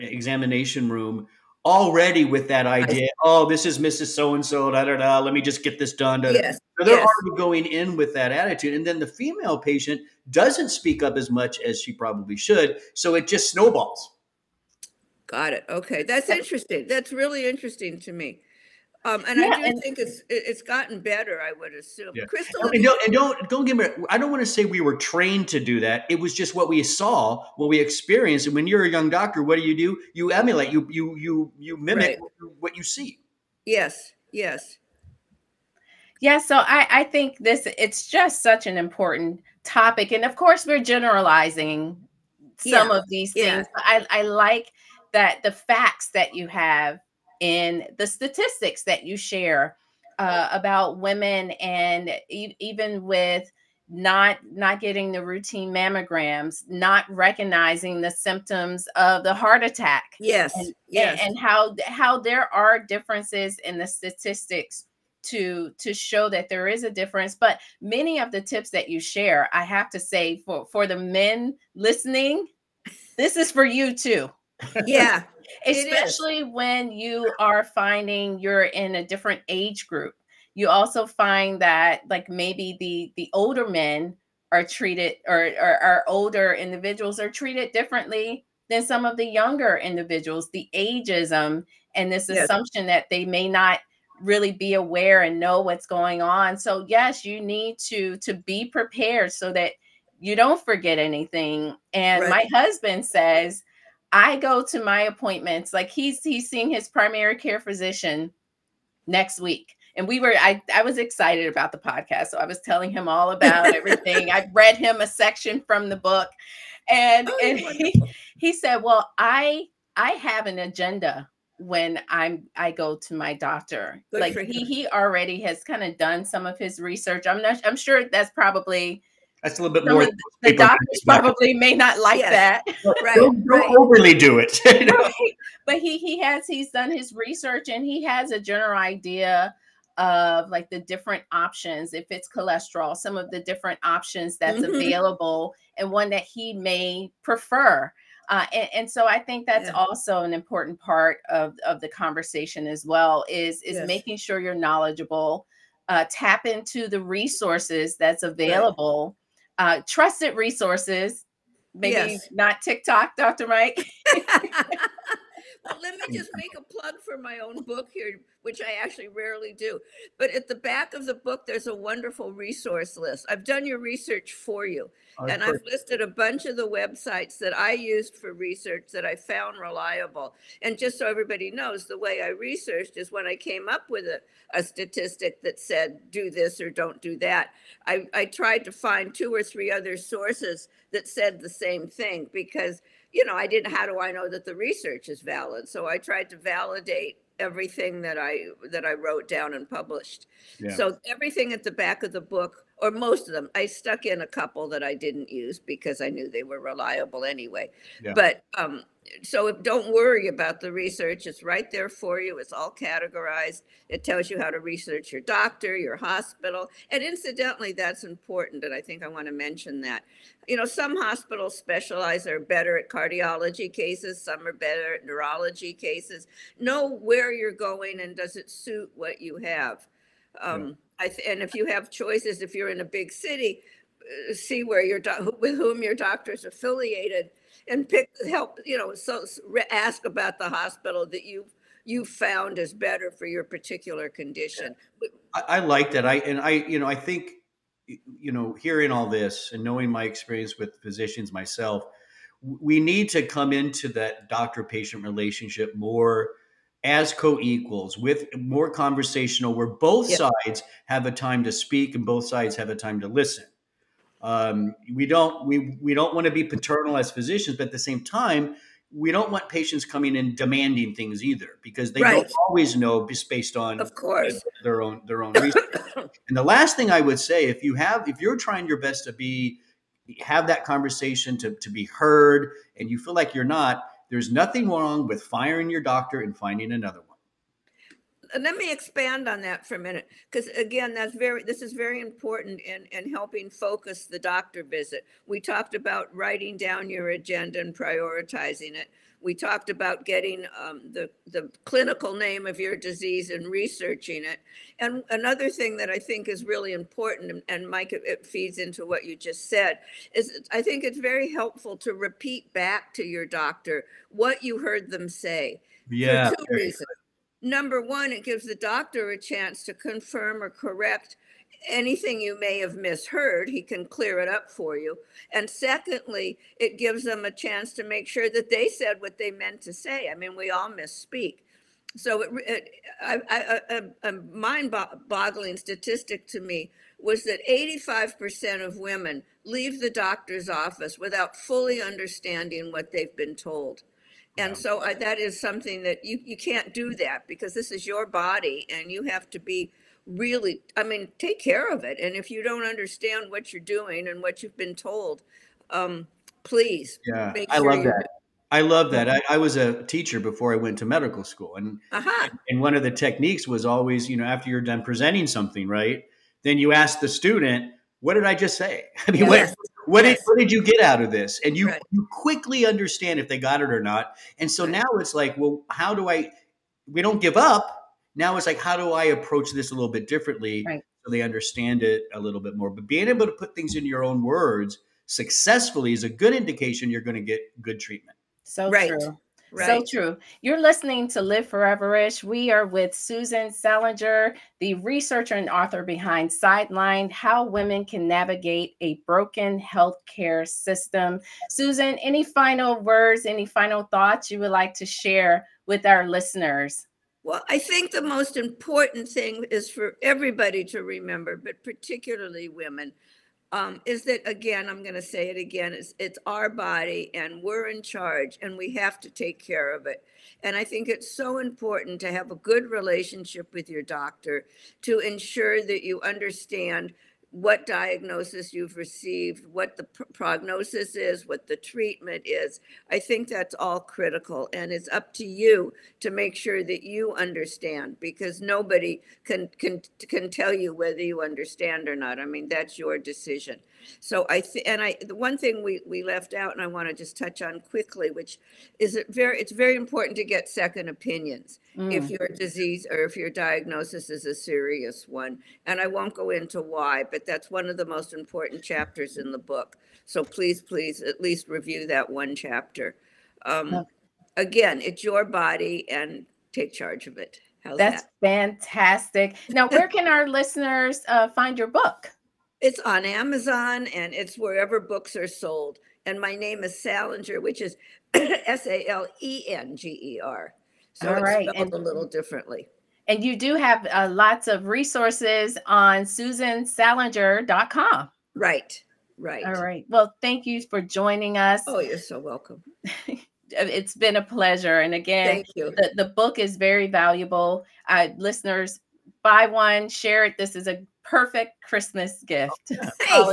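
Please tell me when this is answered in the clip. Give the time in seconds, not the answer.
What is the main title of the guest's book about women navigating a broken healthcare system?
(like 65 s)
396 s.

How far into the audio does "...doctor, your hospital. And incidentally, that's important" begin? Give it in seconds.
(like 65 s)
215 s.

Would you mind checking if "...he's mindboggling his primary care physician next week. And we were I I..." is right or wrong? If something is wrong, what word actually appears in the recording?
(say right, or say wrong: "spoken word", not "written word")
wrong: "seeing", not "mindboggling".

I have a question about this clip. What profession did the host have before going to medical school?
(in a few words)
Teacher.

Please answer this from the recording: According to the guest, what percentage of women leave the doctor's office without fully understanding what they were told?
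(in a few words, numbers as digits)
85%.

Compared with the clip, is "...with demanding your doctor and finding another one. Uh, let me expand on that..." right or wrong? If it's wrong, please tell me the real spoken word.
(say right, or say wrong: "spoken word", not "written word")
wrong: "firing", not "demanding".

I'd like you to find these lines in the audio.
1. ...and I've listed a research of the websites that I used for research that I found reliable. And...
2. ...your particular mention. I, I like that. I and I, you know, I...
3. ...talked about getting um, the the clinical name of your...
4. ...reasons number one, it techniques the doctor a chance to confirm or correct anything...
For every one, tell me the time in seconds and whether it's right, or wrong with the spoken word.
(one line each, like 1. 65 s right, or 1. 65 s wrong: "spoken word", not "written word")
1. 175 s wrong: "bunch", not "research"
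2. 243 s wrong: "condition", not "mention"
3. 299 s right
4. 316 s wrong: "gives", not "techniques".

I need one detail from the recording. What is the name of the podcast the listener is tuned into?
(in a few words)
Live Foreverish.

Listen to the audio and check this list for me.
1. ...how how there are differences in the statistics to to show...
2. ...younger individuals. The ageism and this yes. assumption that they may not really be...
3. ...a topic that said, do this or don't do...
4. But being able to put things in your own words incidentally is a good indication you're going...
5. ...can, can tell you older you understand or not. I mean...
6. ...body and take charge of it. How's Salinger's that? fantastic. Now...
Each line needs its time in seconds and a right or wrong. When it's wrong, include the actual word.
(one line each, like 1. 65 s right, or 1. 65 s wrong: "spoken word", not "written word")
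1. 61 s right
2. 89 s right
3. 184 s wrong: "statistic", not "topic"
4. 382 s wrong: "successfully", not "incidentally"
5. 439 s wrong: "whether", not "older"
6. 465 s wrong: "That", not "Salinger".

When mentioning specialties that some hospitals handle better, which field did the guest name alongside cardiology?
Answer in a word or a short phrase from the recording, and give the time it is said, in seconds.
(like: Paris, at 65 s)
Neurology, at 225 s.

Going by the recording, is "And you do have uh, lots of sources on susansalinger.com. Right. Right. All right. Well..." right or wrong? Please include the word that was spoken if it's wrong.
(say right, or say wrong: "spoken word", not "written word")
wrong: "resources", not "sources".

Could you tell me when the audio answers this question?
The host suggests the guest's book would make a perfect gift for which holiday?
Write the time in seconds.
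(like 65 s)
501 s.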